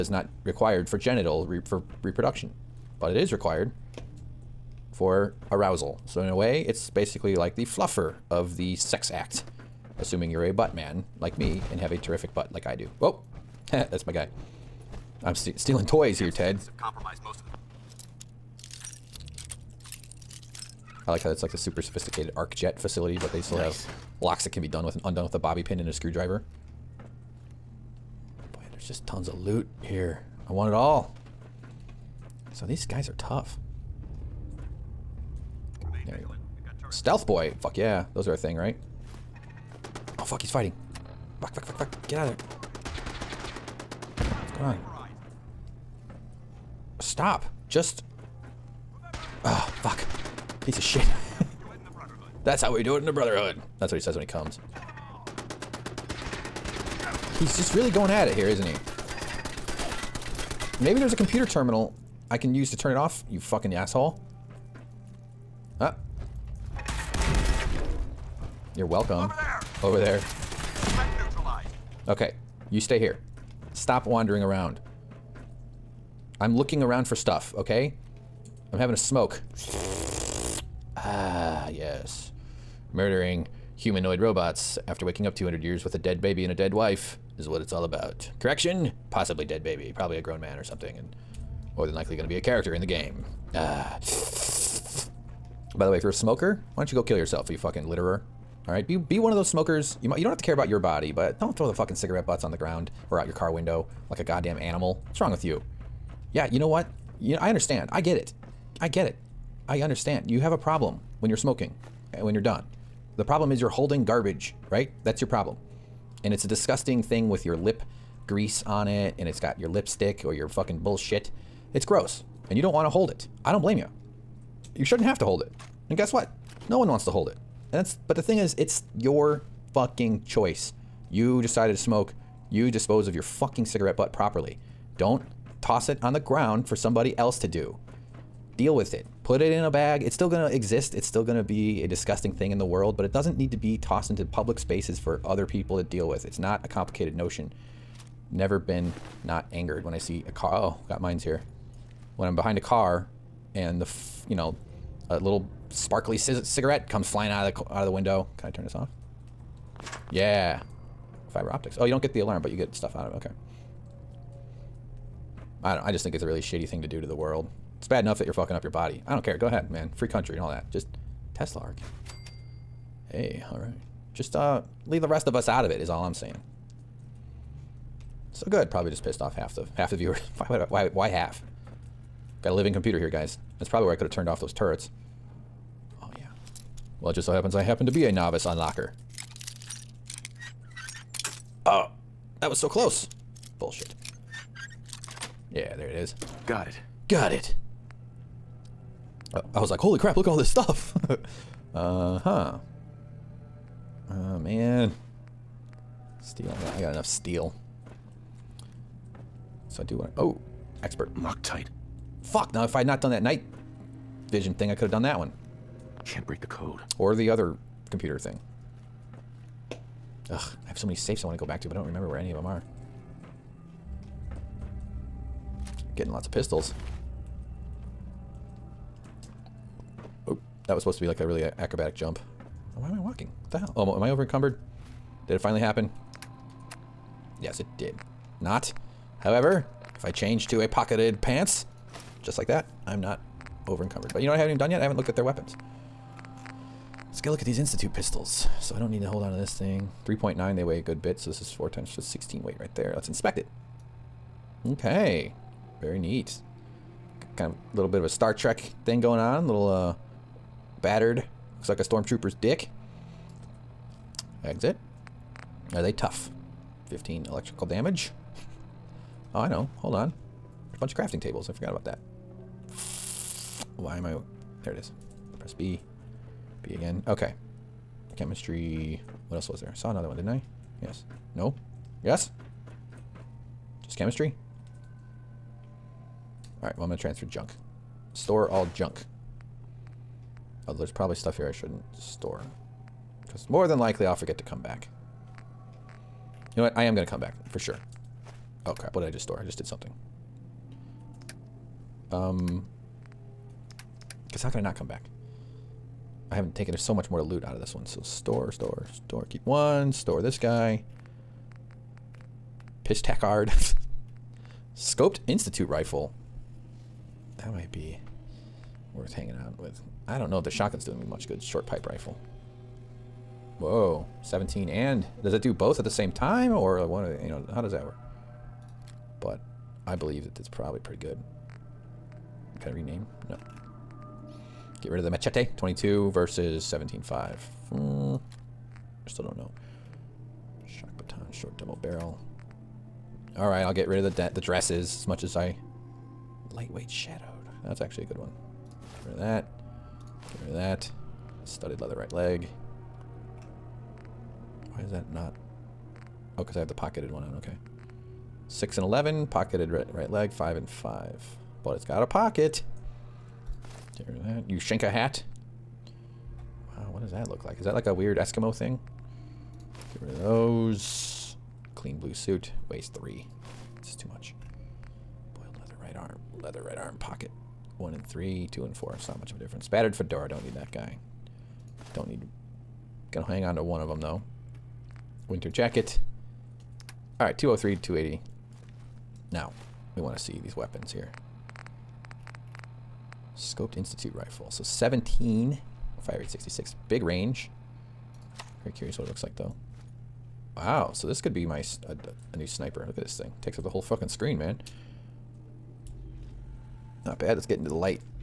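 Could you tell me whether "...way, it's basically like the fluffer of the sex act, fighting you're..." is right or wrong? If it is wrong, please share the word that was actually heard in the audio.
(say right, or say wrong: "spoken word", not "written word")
wrong: "assuming", not "fighting".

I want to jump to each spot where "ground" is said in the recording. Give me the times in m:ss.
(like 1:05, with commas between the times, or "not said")
1:42, 2:16.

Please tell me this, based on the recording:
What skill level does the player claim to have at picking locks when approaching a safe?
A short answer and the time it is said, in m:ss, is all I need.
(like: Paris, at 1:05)
Novice, at 3:08.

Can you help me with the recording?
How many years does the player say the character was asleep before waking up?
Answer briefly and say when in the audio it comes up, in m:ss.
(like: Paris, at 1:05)
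200, at 1:25.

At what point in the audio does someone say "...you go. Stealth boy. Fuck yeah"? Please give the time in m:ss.
0:36.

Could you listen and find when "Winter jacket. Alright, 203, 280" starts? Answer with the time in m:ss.
6:25.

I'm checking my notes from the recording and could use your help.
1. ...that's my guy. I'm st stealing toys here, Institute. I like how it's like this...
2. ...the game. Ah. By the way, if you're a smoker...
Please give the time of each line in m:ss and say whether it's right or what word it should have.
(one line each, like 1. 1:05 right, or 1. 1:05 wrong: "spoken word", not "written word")
1. 0:13 wrong: "Ted", not "Institute"
2. 1:32 right.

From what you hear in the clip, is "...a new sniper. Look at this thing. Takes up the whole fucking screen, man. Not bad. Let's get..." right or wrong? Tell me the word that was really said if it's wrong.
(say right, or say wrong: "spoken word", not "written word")
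right.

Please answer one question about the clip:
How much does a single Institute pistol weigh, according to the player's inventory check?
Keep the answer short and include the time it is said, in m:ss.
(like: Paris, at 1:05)
3.9, at 4:10.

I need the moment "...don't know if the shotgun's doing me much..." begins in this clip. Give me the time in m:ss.
5:20.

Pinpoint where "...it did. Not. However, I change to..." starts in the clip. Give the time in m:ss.
3:57.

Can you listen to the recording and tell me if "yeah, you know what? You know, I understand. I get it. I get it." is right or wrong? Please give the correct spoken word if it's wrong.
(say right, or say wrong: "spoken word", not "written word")
right.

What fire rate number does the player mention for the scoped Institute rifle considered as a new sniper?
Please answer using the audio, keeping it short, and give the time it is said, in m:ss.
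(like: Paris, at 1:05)
66, at 6:36.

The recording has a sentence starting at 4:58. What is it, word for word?
Oh crap, what did I just store?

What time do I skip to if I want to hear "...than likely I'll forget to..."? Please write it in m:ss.
4:53.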